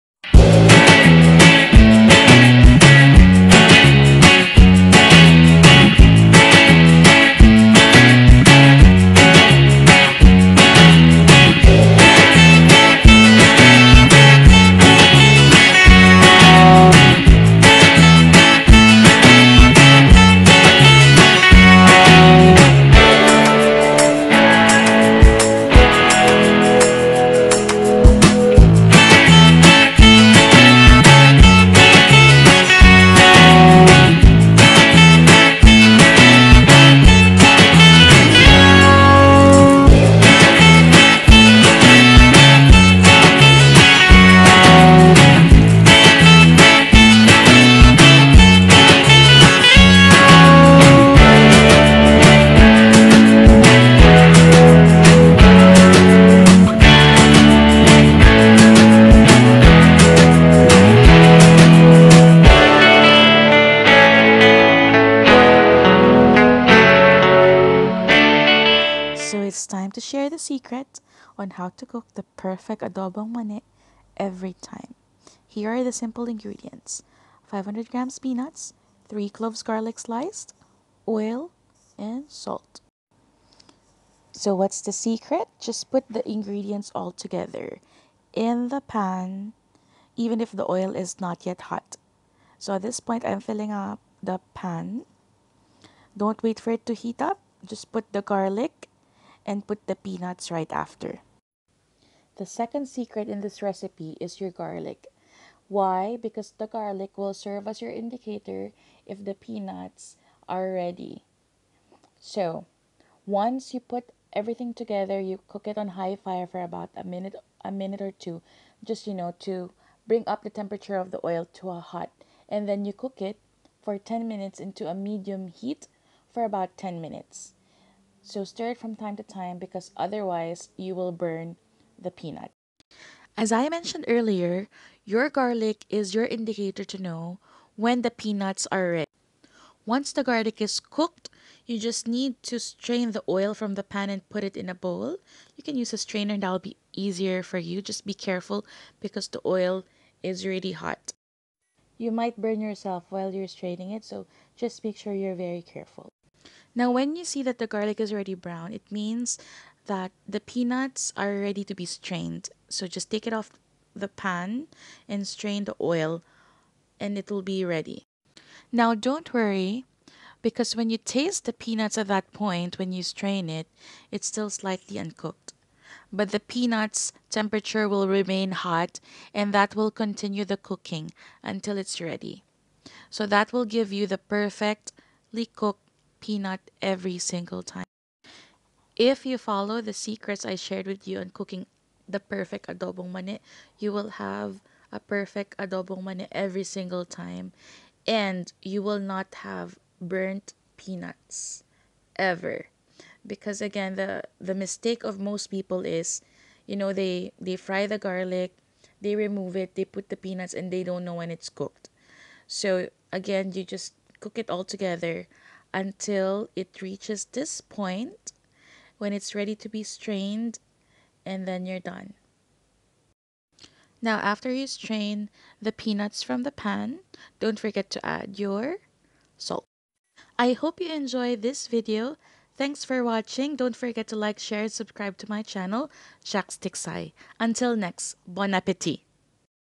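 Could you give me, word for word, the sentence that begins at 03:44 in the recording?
Now after you strain the peanuts from the pan, don't forget to add your salt.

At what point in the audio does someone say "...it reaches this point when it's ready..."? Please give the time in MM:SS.
03:36.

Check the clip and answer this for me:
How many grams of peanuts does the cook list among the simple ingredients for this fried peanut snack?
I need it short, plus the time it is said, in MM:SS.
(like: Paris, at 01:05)
500 grams, at 01:17.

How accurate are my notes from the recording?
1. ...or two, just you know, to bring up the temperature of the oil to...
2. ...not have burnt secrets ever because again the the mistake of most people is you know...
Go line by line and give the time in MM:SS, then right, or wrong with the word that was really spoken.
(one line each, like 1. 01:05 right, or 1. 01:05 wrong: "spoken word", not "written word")
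1. 01:58 right
2. 03:19 wrong: "peanuts", not "secrets".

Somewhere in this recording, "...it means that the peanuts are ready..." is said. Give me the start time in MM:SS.
02:38.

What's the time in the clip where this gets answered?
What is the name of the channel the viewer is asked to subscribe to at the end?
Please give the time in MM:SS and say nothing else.
03:56.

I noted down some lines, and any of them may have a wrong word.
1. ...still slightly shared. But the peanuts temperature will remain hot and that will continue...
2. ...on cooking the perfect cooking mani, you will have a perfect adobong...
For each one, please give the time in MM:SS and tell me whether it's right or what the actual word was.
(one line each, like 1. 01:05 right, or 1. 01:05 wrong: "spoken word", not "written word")
1. 02:54 wrong: "uncooked", not "shared"
2. 03:11 wrong: "adobong", not "cooking".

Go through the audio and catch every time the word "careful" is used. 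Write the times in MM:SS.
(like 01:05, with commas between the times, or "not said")
02:28, 02:35.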